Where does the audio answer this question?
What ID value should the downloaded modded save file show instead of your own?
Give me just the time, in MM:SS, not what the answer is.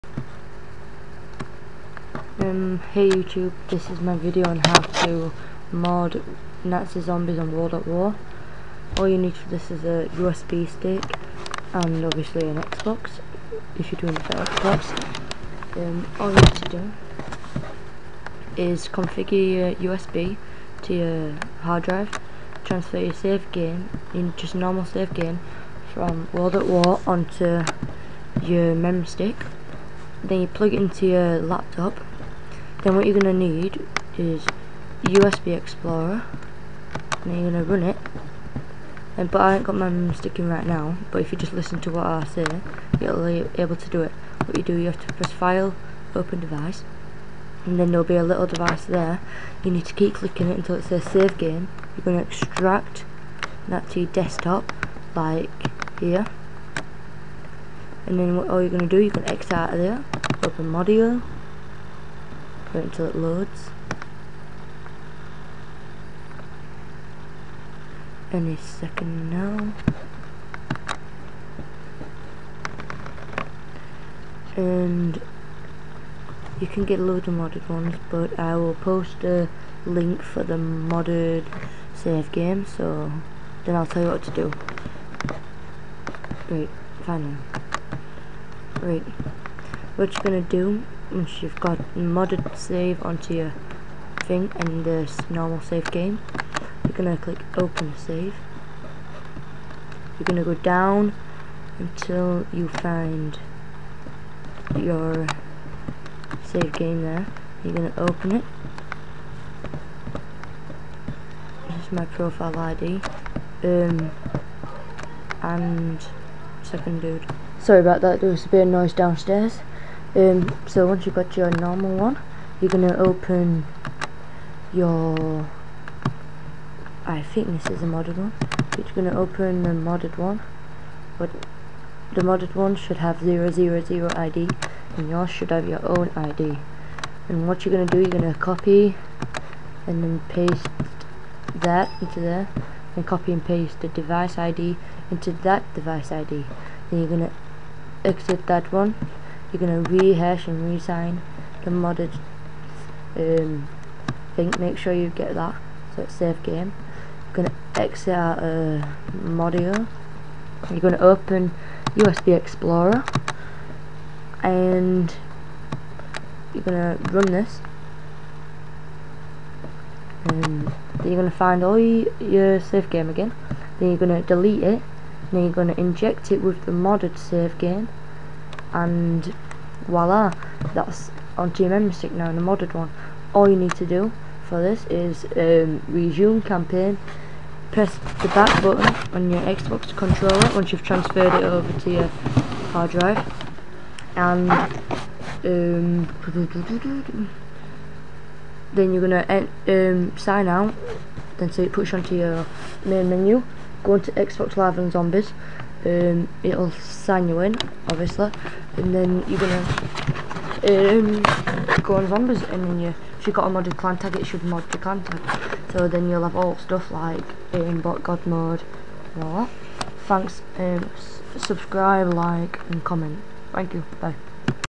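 02:13.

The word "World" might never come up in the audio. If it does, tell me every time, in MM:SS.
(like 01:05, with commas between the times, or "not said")
00:07, 00:26.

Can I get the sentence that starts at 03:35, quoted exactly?
So then you'll have all stuff like um, bot god mode and all that.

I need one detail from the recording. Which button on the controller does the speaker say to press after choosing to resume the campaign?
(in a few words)
back button.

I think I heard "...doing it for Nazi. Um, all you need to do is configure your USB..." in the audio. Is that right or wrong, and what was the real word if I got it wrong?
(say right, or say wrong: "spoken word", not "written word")
wrong: "Xbox", not "Nazi".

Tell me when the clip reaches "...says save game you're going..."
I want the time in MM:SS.
00:50.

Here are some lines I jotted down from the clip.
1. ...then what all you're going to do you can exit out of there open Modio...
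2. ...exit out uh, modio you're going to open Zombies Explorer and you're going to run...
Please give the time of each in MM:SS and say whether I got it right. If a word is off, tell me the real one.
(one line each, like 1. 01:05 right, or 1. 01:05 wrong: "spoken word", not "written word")
1. 00:58 right
2. 02:37 wrong: "USB", not "Zombies".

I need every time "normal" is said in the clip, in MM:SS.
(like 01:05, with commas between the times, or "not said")
00:24, 01:35, 02:01.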